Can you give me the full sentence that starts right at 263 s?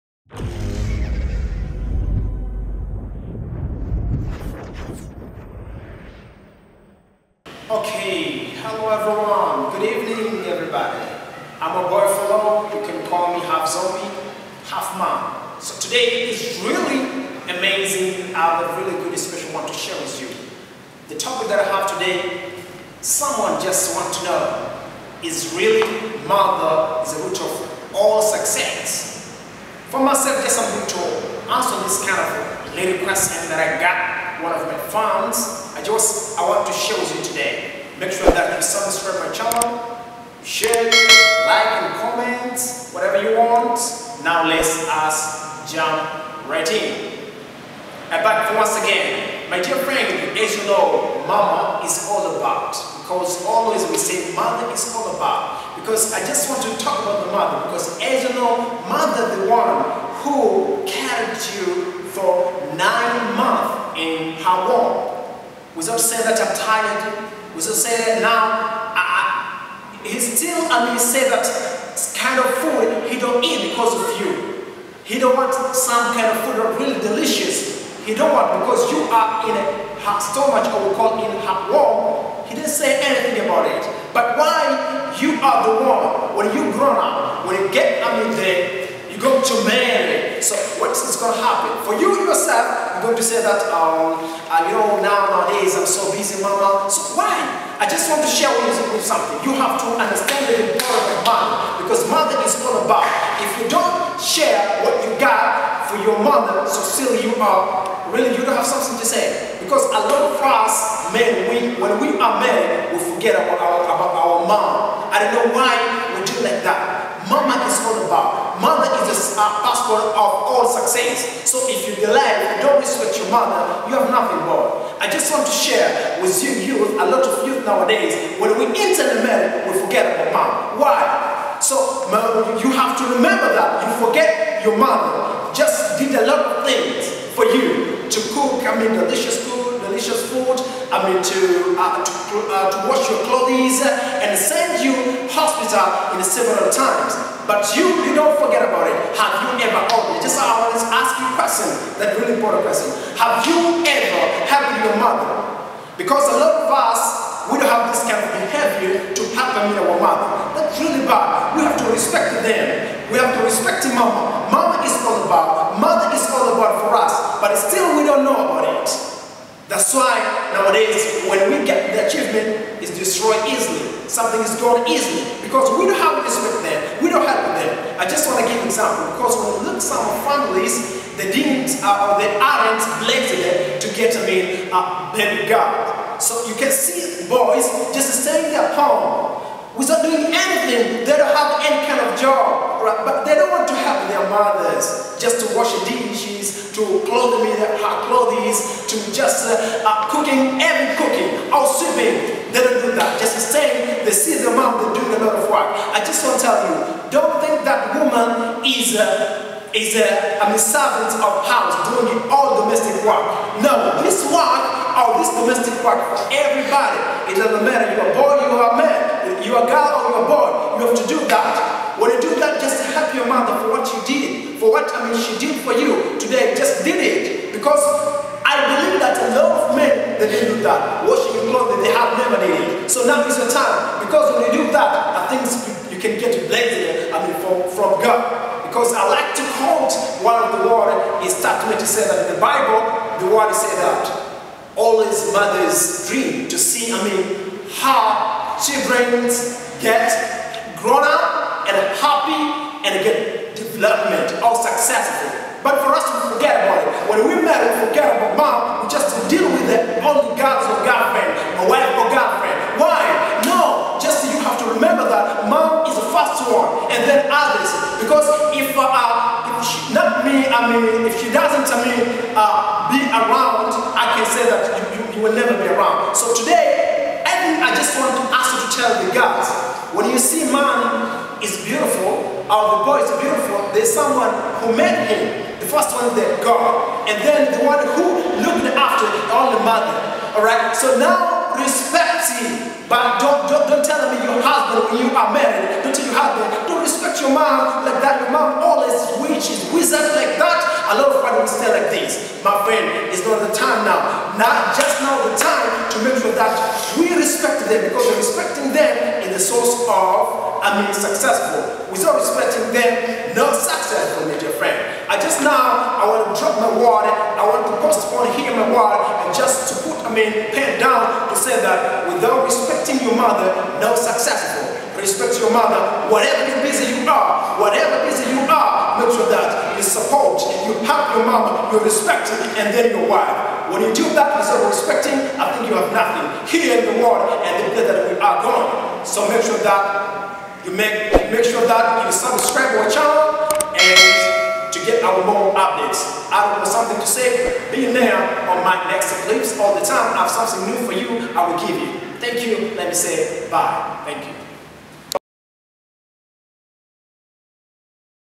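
No, just you have to remember that mom is the first one and then others.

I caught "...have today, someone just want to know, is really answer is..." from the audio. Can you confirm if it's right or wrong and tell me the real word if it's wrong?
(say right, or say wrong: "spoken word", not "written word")
wrong: "mother", not "answer".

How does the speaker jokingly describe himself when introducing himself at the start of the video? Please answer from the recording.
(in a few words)
Half zombie, half man.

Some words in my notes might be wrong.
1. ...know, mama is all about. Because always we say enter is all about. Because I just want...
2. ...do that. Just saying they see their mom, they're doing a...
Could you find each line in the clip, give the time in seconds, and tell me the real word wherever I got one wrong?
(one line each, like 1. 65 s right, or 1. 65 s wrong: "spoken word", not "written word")
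1. 50 s wrong: "mother", not "enter"
2. 202 s right.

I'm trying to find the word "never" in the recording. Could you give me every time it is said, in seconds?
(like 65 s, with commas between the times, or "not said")
232 s, 275 s.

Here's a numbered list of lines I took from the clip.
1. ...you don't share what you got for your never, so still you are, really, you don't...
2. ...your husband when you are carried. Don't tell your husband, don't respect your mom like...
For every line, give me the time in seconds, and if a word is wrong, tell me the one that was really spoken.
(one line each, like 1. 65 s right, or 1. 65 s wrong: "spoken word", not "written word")
1. 103 s wrong: "mother", not "never"
2. 294 s wrong: "married", not "carried".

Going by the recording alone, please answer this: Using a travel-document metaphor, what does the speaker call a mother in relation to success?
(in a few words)
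Passport.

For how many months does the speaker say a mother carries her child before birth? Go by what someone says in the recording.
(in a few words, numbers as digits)
9.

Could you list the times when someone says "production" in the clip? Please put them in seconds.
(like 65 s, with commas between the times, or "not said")
not said.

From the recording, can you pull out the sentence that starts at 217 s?
It doesn't matter, you are boy, you are man, you are girl or you are boy.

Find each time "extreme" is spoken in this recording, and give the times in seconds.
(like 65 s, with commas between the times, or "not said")
not said.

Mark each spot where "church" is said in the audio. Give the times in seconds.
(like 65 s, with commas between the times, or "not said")
not said.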